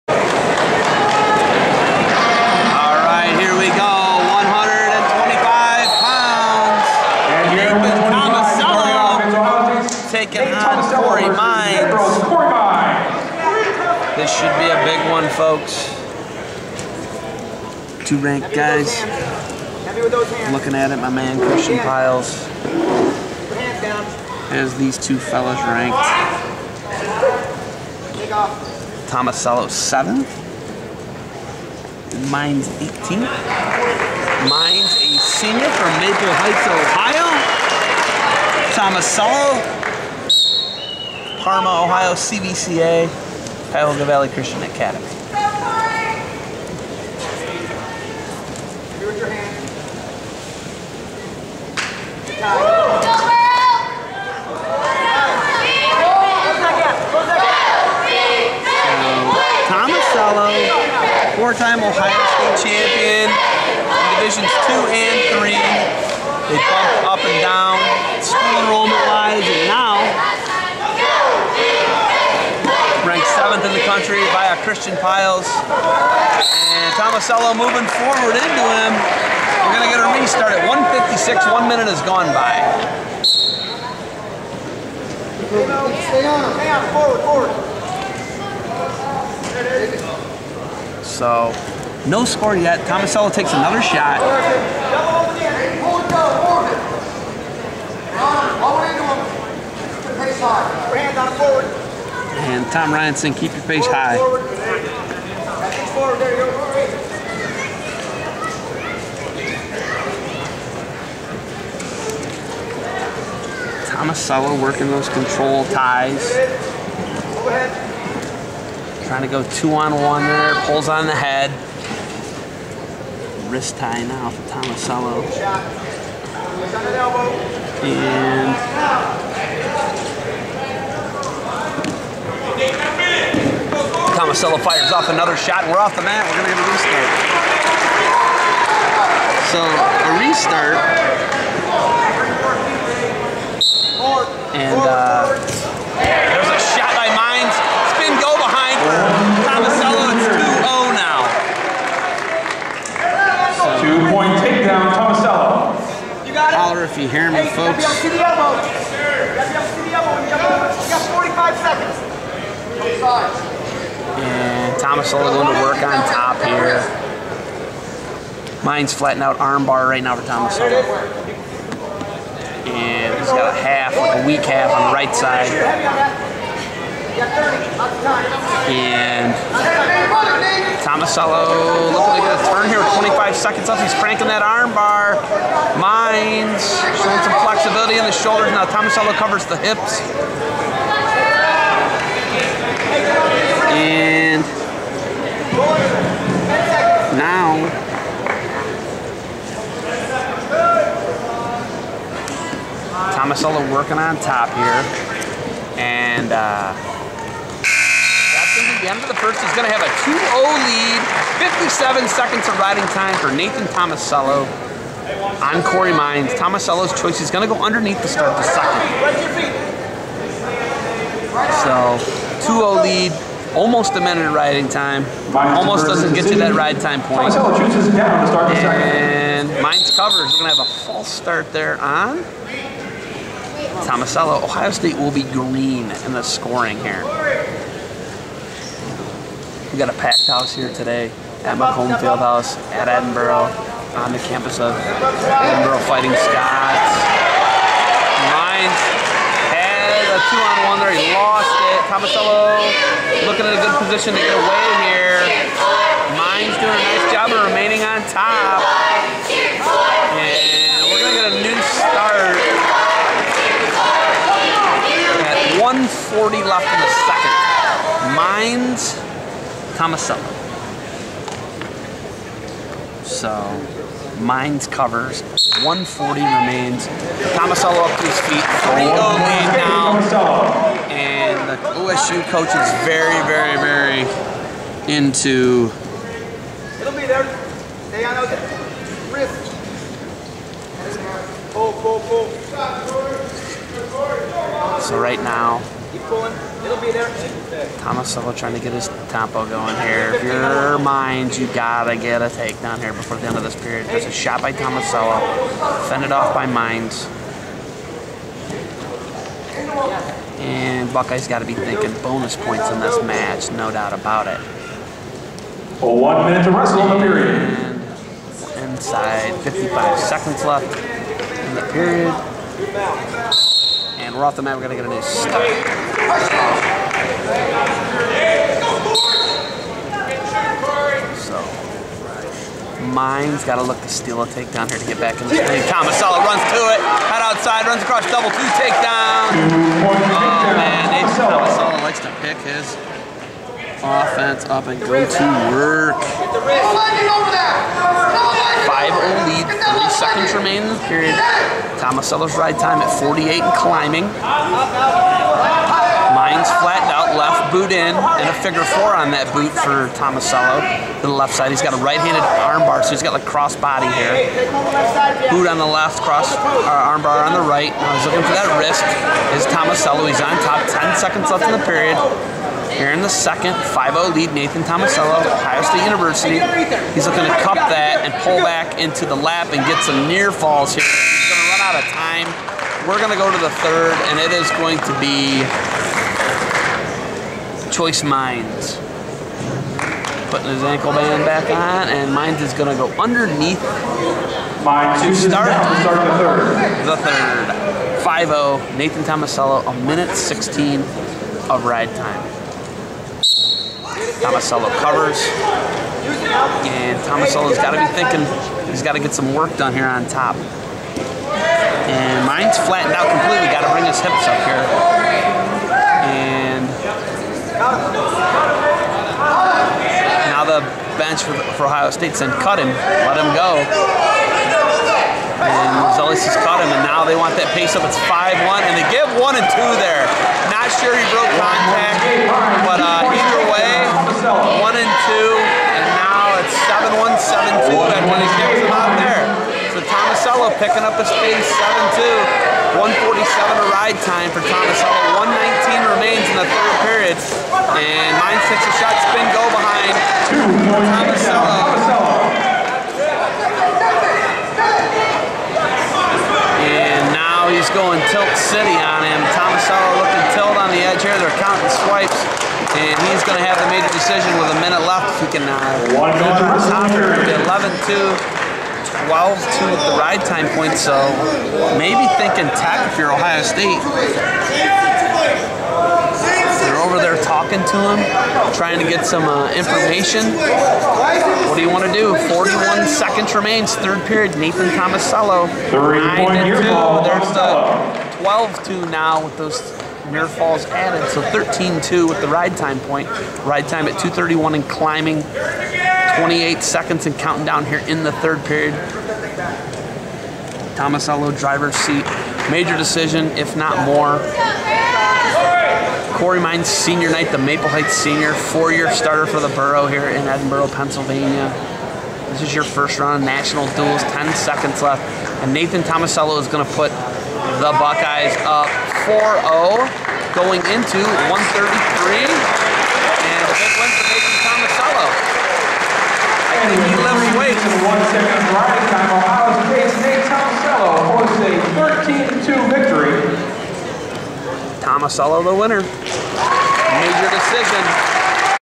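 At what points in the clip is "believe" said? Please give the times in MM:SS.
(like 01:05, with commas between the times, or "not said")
not said.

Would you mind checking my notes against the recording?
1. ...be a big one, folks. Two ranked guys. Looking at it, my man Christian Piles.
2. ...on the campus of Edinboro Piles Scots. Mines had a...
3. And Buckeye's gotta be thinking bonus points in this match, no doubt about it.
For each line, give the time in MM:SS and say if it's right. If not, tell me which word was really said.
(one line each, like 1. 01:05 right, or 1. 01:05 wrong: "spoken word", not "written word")
1. 00:14 right
2. 04:03 wrong: "Fighting", not "Piles"
3. 05:10 right.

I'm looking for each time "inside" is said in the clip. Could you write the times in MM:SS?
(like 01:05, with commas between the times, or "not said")
05:18.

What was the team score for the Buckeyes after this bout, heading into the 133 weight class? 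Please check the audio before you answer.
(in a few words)
4-0.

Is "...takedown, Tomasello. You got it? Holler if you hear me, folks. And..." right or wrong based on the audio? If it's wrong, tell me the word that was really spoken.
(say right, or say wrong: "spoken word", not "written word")
right.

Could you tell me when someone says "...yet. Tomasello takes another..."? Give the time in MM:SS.
01:32.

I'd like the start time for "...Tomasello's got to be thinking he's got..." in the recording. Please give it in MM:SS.
06:47.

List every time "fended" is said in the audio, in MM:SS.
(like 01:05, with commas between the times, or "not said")
05:05.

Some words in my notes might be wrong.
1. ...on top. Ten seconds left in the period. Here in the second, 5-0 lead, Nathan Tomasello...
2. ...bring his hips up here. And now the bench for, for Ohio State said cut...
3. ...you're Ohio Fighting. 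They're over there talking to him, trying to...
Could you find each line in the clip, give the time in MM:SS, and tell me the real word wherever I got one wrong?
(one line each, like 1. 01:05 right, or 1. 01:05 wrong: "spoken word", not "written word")
1. 06:10 right
2. 06:53 right
3. 07:52 wrong: "State", not "Fighting".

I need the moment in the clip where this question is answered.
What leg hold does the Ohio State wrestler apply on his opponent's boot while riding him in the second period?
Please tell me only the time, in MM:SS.
05:58.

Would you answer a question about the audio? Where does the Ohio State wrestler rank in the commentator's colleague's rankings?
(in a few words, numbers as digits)
7th.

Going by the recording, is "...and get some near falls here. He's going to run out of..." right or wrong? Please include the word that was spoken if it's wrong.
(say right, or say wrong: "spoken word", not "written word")
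right.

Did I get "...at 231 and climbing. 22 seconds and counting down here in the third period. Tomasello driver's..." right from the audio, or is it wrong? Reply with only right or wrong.
wrong.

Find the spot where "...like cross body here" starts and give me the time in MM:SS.
06:03.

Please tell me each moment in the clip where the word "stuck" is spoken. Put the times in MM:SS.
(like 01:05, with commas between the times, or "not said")
05:25.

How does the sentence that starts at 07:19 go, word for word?
So Tomasello picking up his pace, seven two, one forty seven two.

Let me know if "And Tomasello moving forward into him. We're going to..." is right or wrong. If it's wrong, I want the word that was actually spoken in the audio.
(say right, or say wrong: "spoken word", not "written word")
right.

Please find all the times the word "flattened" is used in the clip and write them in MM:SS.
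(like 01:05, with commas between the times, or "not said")
02:48, 05:56, 06:52.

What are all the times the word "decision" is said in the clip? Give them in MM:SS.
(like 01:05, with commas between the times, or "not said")
07:43, 08:22, 08:57.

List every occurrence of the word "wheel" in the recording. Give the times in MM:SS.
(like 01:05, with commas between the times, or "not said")
not said.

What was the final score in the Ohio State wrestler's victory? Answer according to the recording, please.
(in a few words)
13-2.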